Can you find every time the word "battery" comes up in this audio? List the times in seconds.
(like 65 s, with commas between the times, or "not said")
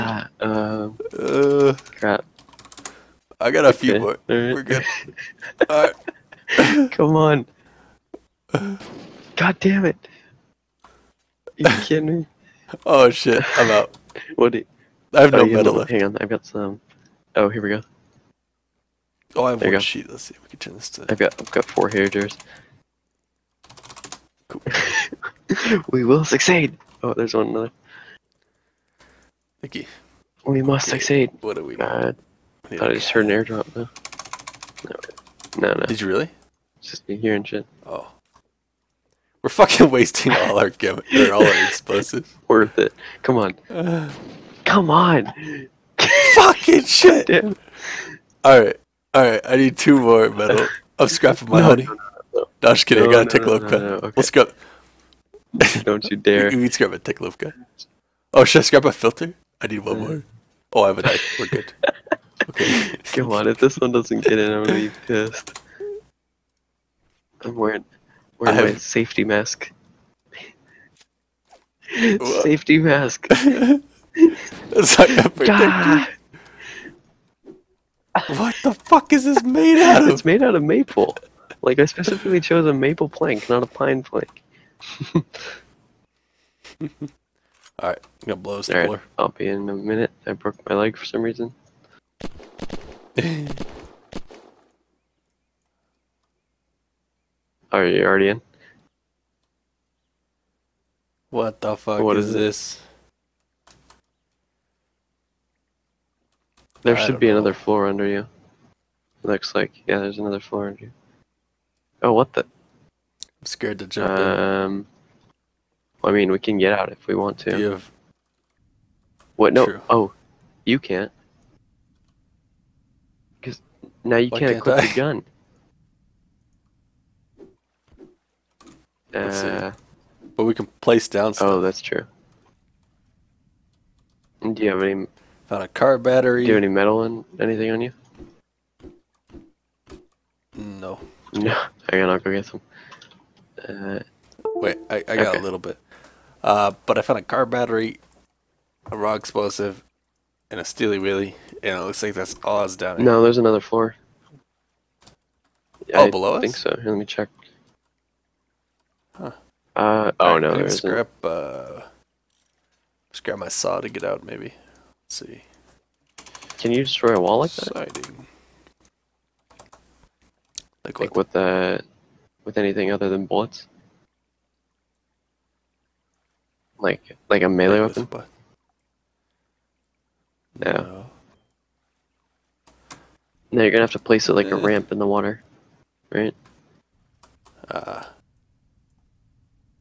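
135 s, 147 s.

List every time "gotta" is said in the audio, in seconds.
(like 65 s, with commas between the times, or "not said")
53 s, 141 s.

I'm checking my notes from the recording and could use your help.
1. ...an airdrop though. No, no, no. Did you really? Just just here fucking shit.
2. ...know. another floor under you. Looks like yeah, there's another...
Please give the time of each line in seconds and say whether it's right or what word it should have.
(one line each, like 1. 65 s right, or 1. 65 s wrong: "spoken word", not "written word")
1. 33 s wrong: "hearing", not "fucking"
2. 107 s right.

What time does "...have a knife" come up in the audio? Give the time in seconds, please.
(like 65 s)
60 s.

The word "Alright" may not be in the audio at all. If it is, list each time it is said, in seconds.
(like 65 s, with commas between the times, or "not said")
87 s.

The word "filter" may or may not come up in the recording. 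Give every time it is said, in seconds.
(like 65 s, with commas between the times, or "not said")
58 s.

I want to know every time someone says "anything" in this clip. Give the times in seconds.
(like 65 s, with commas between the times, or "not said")
137 s, 172 s.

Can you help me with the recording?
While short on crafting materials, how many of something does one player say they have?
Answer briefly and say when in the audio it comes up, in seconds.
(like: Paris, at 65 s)
4, at 21 s.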